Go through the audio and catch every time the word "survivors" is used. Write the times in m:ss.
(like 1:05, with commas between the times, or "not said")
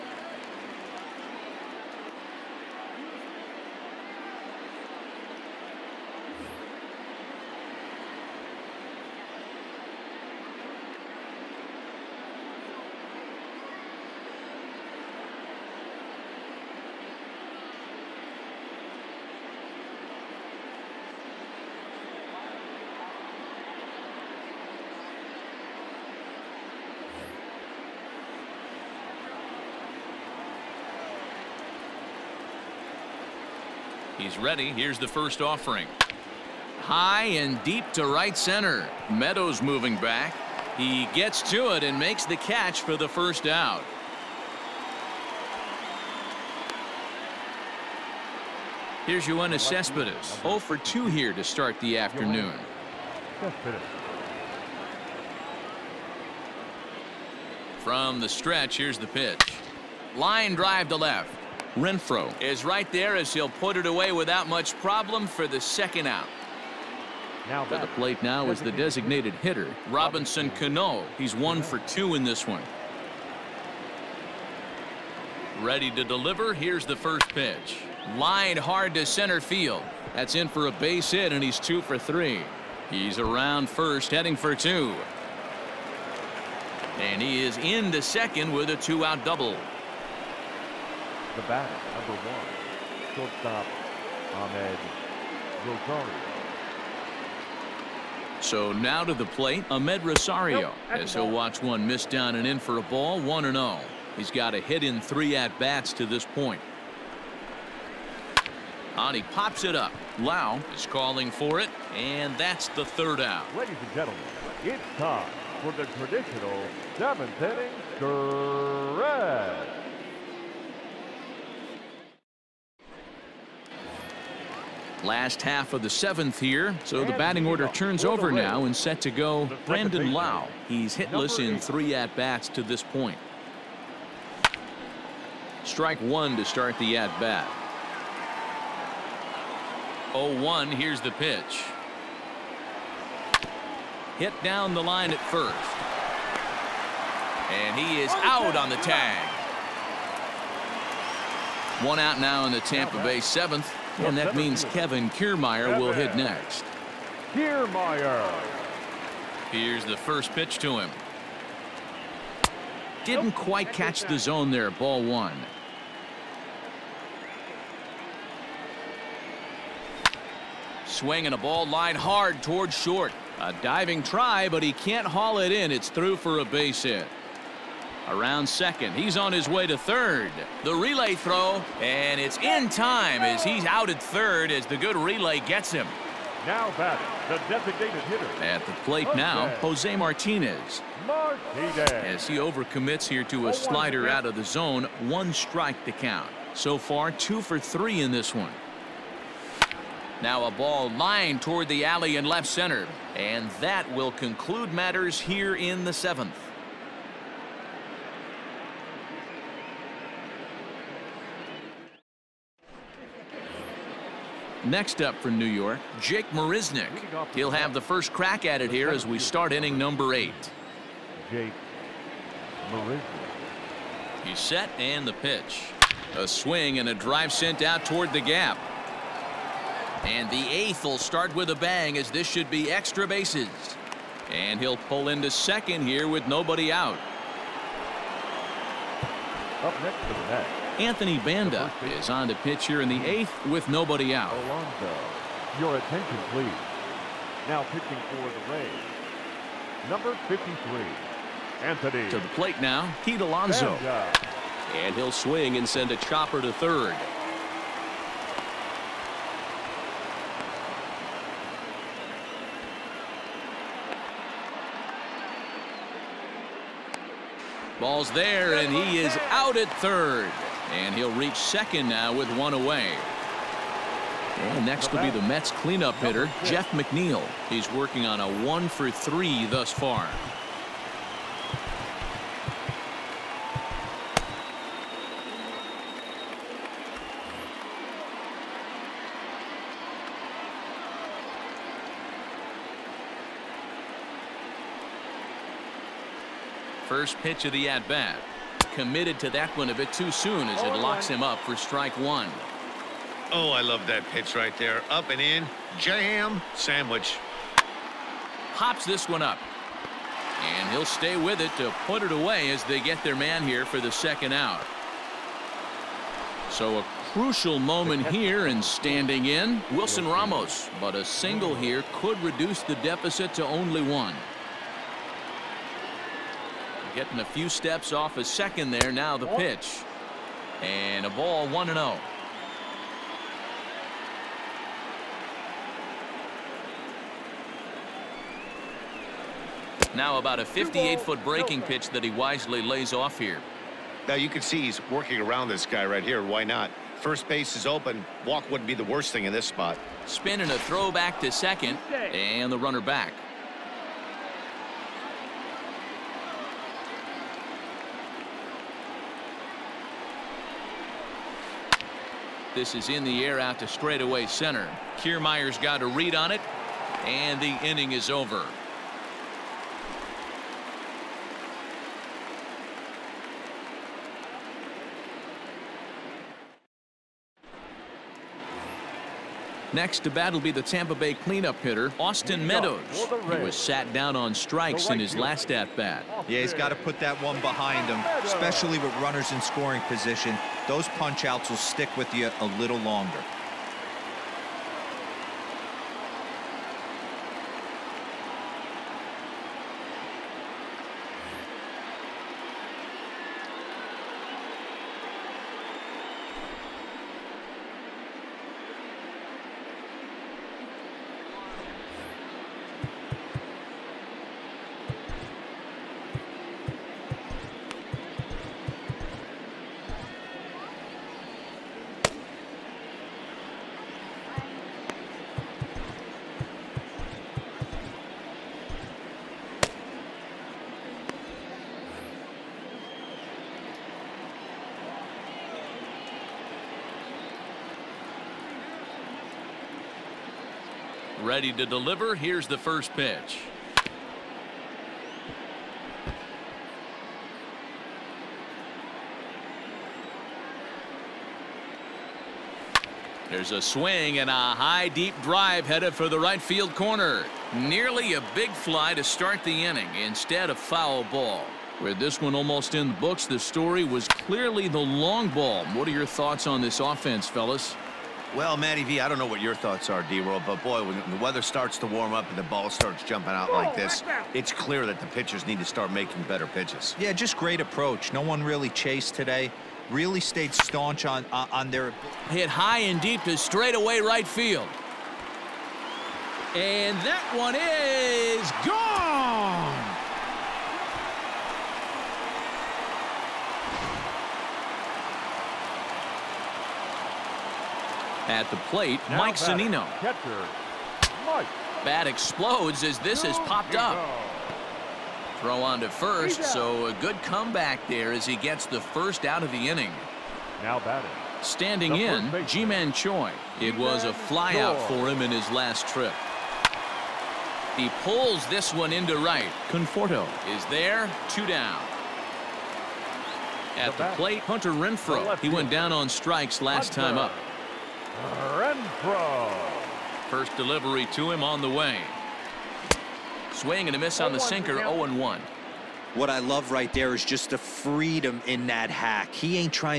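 not said.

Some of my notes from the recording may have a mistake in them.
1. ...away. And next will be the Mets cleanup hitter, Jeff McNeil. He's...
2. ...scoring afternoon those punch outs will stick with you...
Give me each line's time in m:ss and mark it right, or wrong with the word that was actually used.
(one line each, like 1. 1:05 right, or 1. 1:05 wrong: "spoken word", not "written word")
1. 4:32 right
2. 6:29 wrong: "position", not "afternoon".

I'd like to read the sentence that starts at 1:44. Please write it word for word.
He's got a hit in three at bats to this point.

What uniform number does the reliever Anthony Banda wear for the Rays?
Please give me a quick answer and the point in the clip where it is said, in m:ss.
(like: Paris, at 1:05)
53, at 4:10.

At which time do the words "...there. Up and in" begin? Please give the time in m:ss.
5:04.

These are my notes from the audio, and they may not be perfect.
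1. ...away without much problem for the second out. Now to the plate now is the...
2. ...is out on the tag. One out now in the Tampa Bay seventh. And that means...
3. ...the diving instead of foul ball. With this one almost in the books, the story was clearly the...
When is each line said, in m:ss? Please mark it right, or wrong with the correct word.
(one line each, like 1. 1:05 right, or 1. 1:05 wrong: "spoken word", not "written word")
1. 1:03 right
2. 2:28 right
3. 7:39 wrong: "inning", not "diving".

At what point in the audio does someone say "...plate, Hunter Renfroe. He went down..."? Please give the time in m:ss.
8:44.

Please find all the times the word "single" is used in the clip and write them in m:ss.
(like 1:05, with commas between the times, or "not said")
5:21.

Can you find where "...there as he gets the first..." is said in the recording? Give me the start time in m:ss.
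8:27.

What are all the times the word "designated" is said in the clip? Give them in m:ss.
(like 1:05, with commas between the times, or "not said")
1:08, 3:07.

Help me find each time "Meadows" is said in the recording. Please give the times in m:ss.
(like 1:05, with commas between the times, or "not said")
0:39, 6:22.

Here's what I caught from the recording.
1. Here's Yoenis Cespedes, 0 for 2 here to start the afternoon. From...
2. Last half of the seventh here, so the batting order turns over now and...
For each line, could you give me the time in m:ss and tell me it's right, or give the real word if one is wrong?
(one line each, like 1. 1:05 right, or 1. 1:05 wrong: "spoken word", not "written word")
1. 0:49 right
2. 2:05 right.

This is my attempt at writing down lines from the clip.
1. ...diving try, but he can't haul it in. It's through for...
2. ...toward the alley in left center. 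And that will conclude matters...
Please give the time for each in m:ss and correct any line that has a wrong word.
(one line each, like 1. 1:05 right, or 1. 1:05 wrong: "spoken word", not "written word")
1. 2:53 right
2. 3:21 right.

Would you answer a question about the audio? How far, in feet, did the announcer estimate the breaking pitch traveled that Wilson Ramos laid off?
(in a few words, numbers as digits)
58.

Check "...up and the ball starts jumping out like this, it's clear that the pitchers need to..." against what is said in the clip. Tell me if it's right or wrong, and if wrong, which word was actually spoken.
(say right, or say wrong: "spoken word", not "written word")
right.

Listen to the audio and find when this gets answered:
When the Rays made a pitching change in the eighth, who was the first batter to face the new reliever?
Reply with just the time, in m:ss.
4:13.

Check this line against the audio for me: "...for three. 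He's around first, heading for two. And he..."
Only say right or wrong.
right.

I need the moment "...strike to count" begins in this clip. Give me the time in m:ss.
3:15.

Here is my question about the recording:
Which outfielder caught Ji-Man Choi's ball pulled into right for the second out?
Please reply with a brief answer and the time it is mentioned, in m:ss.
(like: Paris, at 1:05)
Conforto, at 8:39.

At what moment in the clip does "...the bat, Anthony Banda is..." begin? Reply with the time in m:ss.
4:00.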